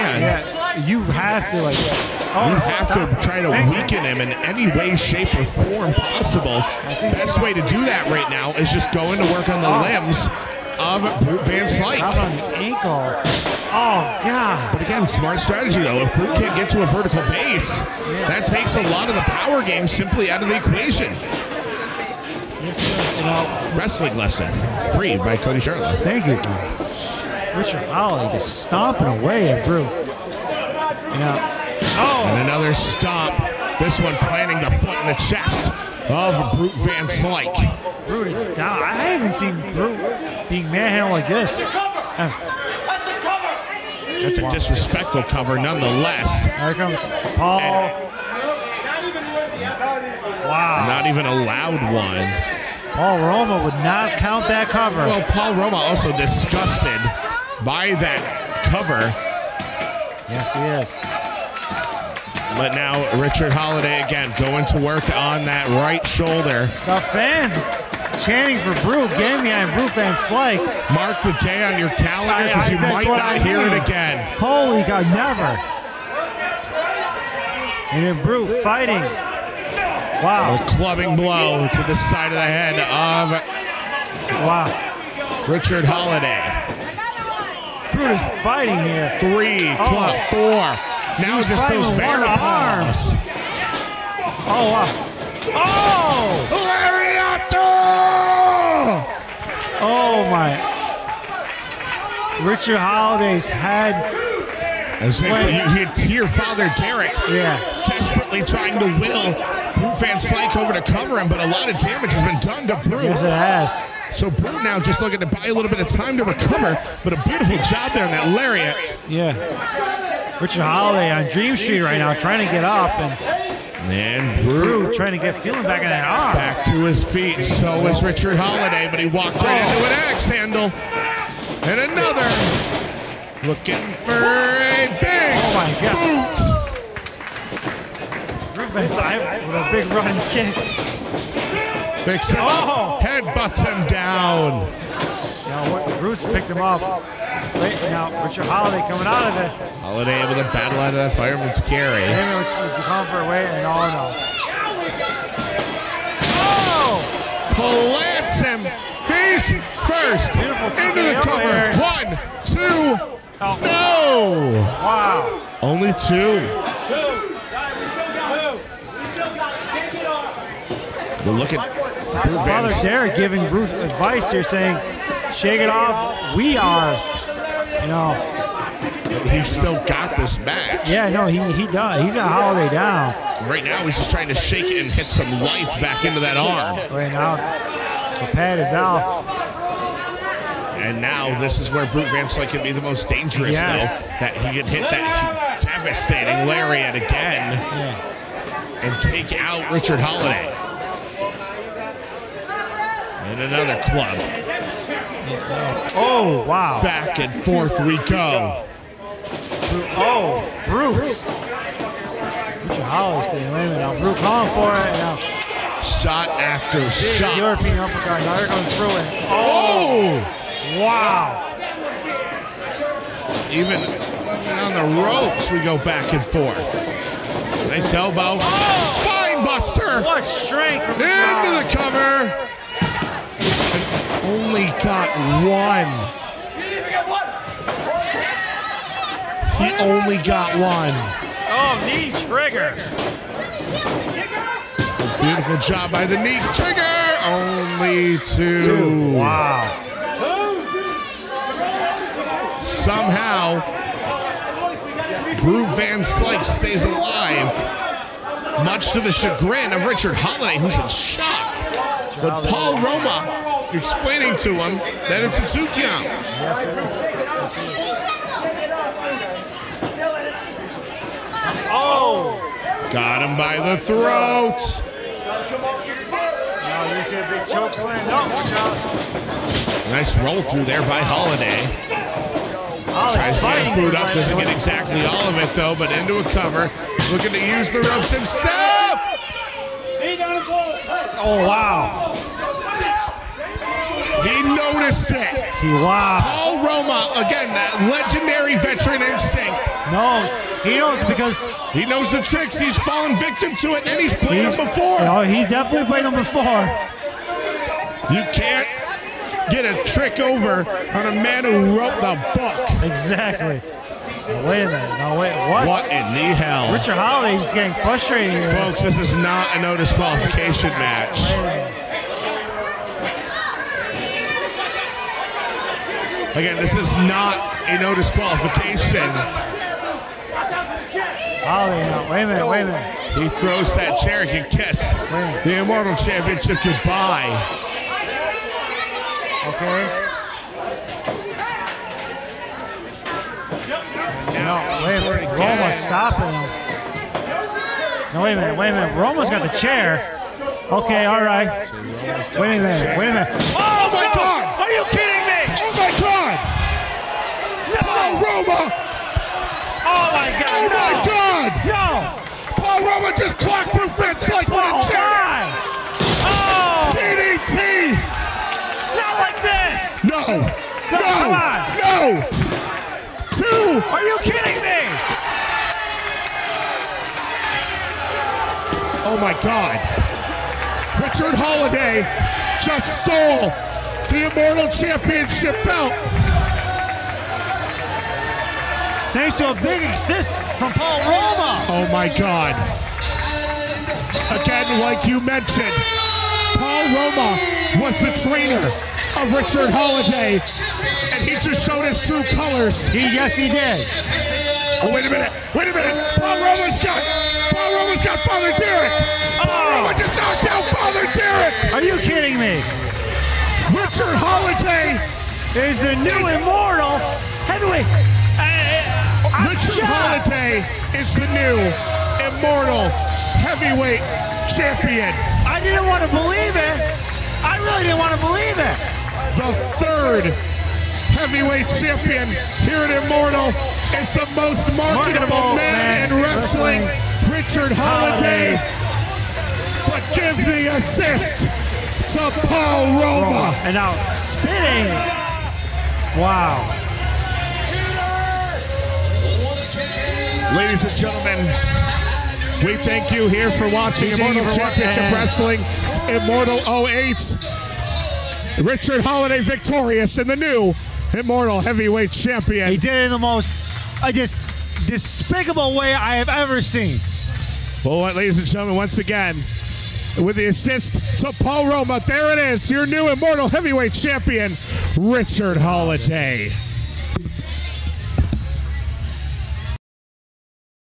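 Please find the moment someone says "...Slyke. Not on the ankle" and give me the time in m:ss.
0:11.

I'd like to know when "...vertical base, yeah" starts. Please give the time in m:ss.
0:16.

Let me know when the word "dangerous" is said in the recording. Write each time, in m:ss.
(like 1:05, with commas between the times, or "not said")
3:13.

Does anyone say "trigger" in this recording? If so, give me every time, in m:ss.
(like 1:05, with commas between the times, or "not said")
4:02, 4:06.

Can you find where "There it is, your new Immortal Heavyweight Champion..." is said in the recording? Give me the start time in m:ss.
7:52.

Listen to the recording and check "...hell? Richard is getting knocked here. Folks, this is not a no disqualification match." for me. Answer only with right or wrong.
wrong.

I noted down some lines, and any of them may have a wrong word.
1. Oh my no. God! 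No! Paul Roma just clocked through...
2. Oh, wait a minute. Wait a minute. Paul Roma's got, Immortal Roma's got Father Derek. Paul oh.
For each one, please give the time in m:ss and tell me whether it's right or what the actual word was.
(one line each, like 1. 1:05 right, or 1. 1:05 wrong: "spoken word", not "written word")
1. 6:00 right
2. 6:44 wrong: "Paul", not "Immortal".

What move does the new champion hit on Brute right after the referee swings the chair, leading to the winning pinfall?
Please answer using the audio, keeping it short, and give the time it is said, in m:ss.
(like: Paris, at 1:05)
DDT, at 6:06.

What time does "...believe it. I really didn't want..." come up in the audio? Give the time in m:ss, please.
7:06.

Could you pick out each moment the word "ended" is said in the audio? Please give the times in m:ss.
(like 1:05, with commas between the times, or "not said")
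not said.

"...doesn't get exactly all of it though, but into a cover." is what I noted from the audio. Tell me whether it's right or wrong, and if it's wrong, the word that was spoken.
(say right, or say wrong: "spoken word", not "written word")
right.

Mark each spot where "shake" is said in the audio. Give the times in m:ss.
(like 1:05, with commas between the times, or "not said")
2:55, 3:04.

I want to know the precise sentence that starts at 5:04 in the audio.
Oh, he's definitely played them before.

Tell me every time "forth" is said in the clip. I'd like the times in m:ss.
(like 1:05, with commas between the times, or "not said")
3:27, 3:46.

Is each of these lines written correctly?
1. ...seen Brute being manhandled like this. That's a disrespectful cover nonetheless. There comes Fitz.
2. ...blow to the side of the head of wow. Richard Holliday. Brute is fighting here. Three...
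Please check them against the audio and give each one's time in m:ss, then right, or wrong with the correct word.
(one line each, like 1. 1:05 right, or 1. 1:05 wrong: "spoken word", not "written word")
1. 0:39 wrong: "Paul", not "Fitz"
2. 1:21 right.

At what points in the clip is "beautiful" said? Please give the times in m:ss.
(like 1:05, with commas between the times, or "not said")
1:57, 4:05.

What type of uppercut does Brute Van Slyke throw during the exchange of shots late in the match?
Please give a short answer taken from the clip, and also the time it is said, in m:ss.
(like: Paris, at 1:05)
European uppercut, at 3:37.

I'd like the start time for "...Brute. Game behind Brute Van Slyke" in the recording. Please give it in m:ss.
1:08.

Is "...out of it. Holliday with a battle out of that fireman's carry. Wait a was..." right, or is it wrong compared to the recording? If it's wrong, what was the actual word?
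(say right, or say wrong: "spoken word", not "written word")
right.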